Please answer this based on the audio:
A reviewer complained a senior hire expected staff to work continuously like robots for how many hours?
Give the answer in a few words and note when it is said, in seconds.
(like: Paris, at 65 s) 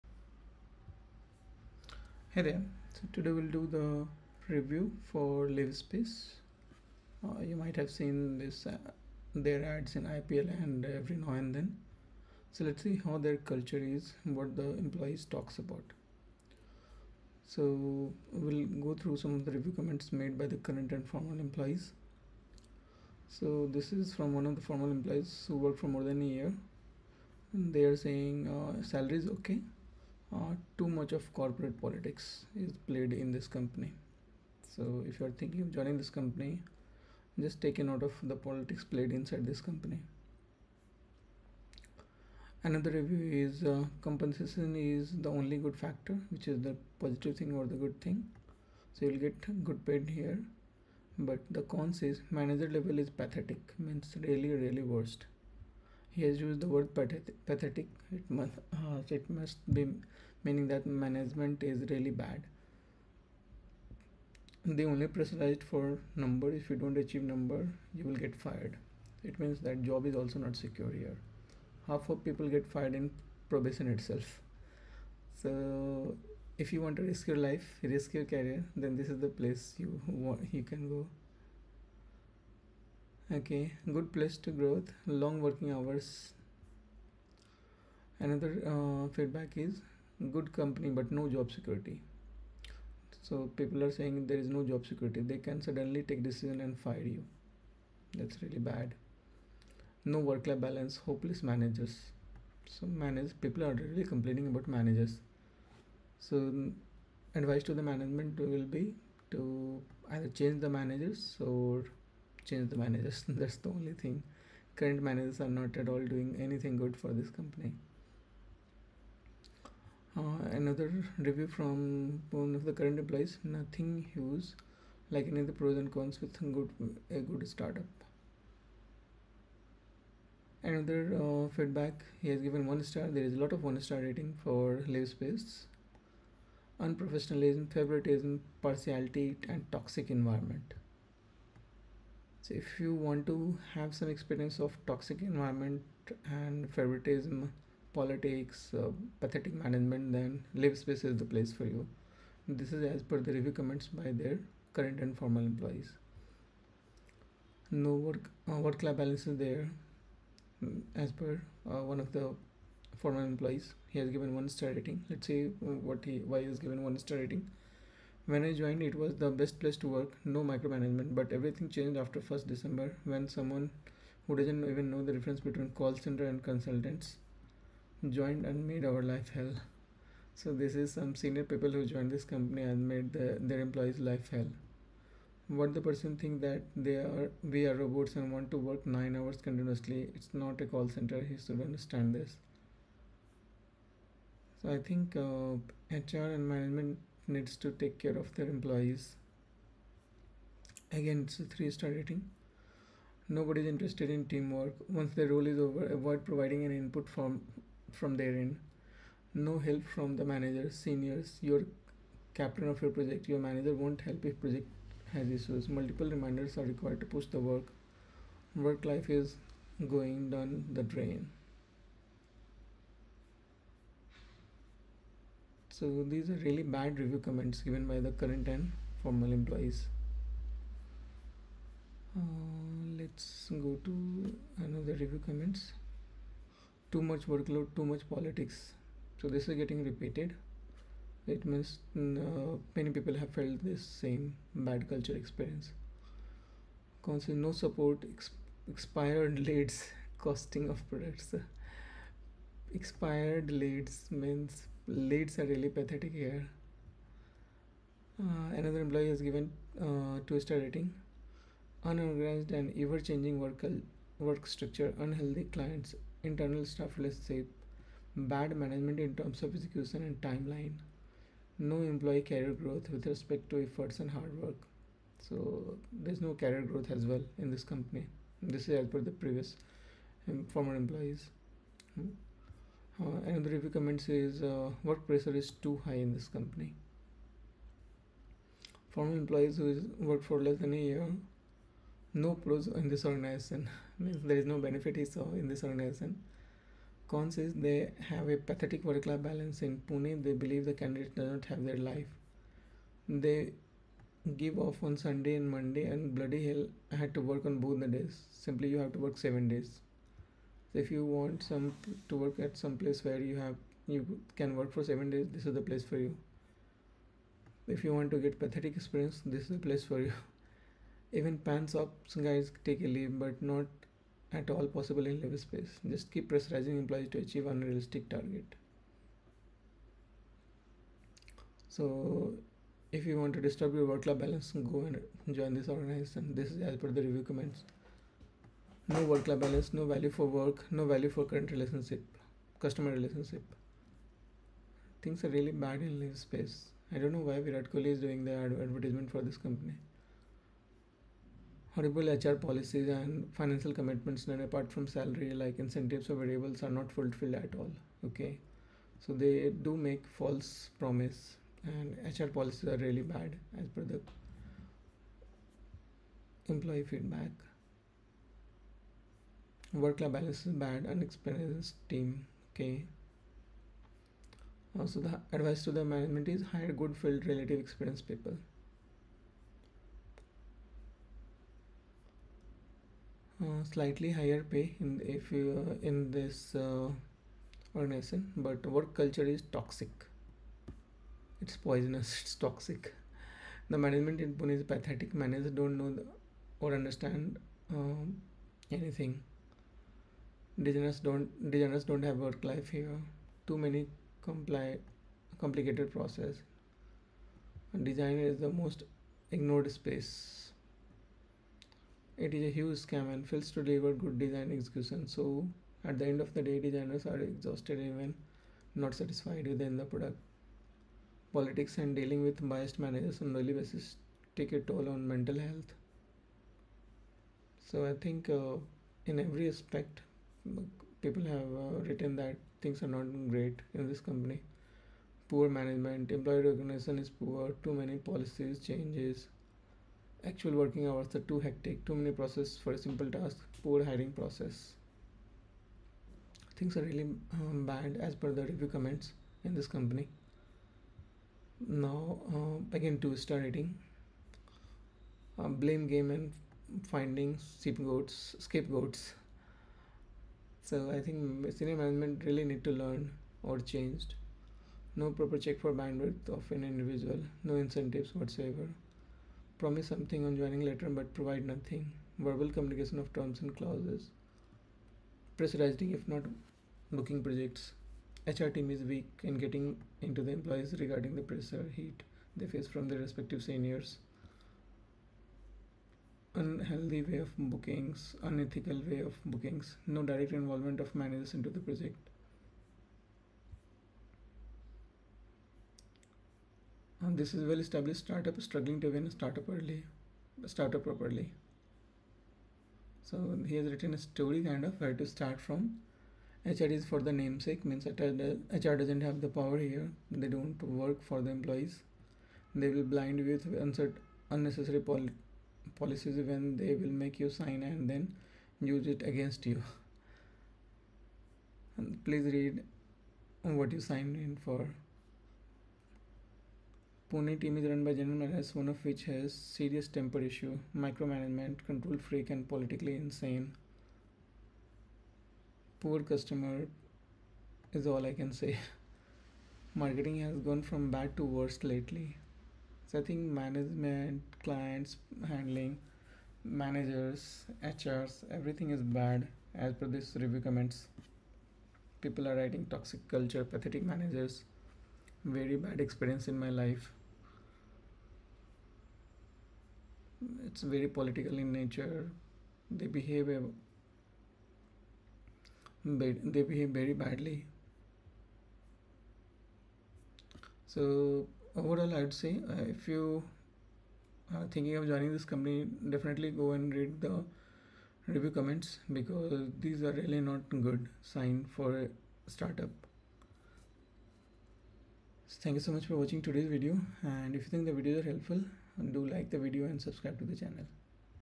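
9, at 188 s.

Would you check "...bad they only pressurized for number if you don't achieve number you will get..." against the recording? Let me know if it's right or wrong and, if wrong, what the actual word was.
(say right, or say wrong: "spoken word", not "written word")
right.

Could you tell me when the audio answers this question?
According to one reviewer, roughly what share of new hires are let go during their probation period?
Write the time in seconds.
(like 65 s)
71 s.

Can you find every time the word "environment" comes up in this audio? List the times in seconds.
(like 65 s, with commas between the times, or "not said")
140 s, 145 s.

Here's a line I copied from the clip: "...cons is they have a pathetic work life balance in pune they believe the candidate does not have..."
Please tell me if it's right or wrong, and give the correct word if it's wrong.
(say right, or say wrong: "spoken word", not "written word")
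right.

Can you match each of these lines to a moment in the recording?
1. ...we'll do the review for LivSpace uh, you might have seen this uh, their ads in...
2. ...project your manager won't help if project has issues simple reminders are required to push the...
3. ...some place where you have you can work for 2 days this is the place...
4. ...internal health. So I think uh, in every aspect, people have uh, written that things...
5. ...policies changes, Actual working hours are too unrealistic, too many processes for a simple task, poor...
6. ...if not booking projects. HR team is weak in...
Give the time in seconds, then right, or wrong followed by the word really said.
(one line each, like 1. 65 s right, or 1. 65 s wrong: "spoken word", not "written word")
1. 3 s right
2. 212 s wrong: "multiple", not "simple"
3. 312 s wrong: "7", not "2"
4. 425 s wrong: "mental", not "internal"
5. 437 s wrong: "hectic", not "unrealistic"
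6. 475 s right.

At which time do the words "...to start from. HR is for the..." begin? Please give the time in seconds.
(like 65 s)
504 s.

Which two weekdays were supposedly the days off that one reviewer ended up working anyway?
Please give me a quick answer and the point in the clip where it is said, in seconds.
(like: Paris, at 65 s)
Sunday and Monday, at 304 s.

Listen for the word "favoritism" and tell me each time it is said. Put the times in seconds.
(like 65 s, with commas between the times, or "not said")
137 s, 146 s.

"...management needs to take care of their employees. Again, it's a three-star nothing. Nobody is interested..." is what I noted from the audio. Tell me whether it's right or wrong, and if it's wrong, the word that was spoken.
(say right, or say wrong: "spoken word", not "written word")
wrong: "rating", not "nothing".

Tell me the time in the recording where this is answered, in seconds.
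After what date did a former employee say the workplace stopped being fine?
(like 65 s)
172 s.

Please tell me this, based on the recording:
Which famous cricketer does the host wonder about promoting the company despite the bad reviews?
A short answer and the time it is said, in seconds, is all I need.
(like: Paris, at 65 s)
Virat Kohli, at 347 s.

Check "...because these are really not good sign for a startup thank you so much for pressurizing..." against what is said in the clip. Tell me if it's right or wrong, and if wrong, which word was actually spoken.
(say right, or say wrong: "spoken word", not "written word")
wrong: "watching", not "pressurizing".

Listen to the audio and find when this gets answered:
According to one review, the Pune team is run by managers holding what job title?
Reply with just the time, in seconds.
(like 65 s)
527 s.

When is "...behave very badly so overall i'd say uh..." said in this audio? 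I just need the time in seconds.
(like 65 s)
566 s.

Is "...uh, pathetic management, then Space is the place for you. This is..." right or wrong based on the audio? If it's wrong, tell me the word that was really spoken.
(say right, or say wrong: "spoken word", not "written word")
right.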